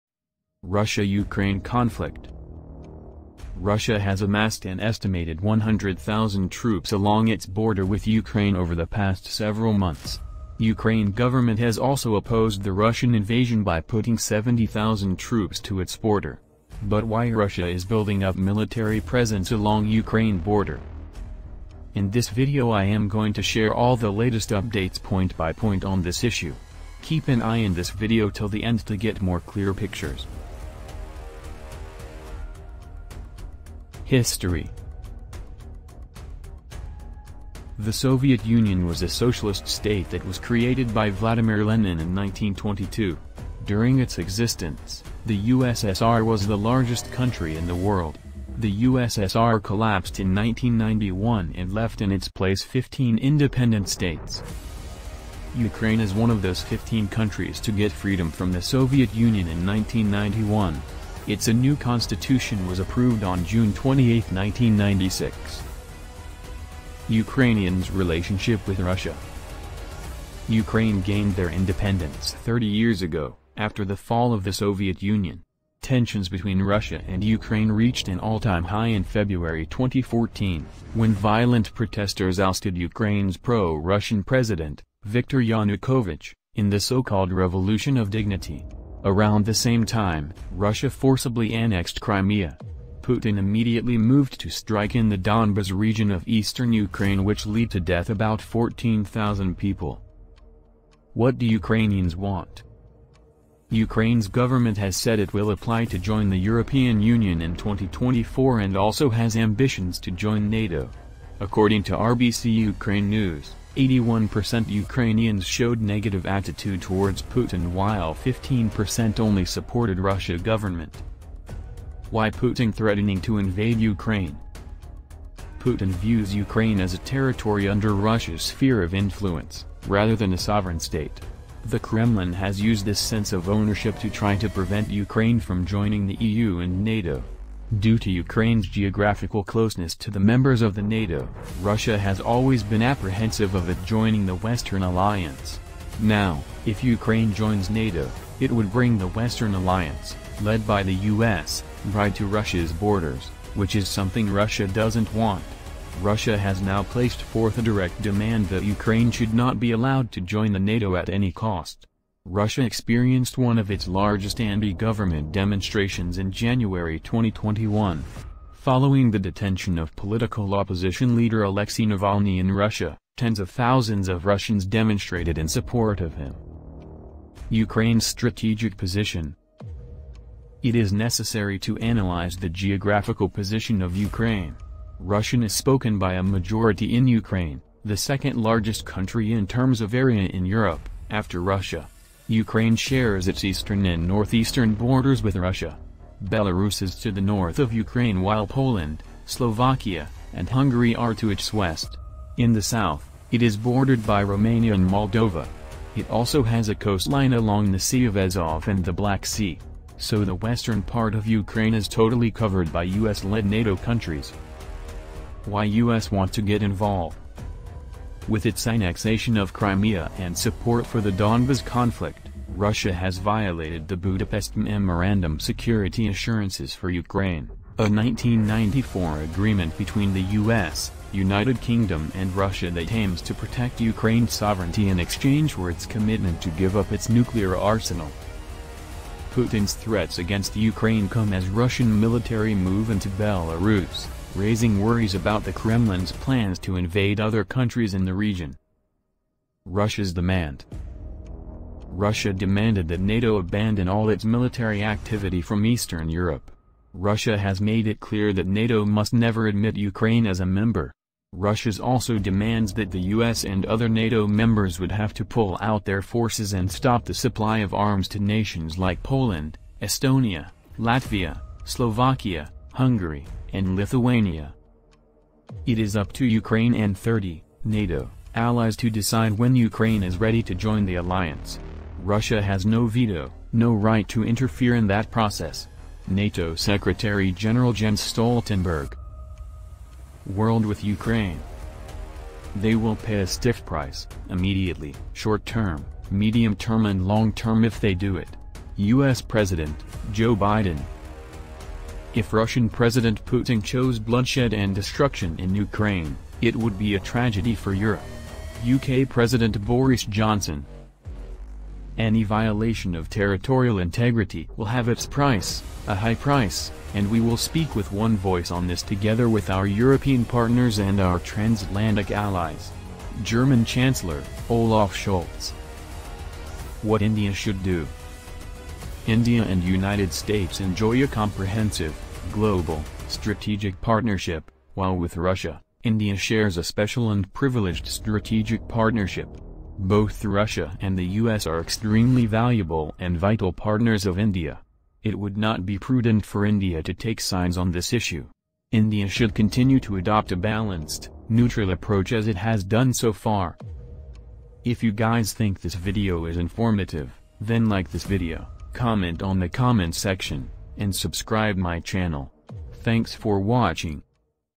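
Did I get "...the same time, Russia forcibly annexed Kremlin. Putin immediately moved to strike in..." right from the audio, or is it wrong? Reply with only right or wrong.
wrong.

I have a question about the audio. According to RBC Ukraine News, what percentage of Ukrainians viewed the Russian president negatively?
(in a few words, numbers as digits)
81%.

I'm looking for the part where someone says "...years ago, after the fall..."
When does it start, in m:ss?
1:12.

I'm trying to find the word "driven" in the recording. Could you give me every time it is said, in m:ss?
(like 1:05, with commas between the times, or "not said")
not said.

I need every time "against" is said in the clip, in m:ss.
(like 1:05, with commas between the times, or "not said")
4:00.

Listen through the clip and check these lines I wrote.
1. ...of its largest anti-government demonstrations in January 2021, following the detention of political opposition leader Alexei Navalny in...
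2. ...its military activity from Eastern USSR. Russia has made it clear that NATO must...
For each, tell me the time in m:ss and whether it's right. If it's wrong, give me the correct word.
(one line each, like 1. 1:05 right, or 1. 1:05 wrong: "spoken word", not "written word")
1. 2:43 right
2. 4:14 wrong: "Europe", not "USSR".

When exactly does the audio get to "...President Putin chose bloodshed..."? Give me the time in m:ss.
5:02.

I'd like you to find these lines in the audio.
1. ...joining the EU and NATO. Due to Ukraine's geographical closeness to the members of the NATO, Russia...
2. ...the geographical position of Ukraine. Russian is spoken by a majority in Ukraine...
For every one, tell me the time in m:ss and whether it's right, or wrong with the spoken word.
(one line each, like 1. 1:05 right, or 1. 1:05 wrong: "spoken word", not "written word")
1. 2:15 right
2. 3:02 right.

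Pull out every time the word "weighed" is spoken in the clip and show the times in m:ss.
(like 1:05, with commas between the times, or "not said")
not said.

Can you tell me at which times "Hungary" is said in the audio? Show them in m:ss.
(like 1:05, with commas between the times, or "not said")
3:20, 4:32.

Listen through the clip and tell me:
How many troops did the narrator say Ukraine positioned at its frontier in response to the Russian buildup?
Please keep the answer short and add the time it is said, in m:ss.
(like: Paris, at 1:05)
70,000, at 0:14.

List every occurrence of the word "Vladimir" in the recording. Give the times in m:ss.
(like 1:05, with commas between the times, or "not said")
0:41.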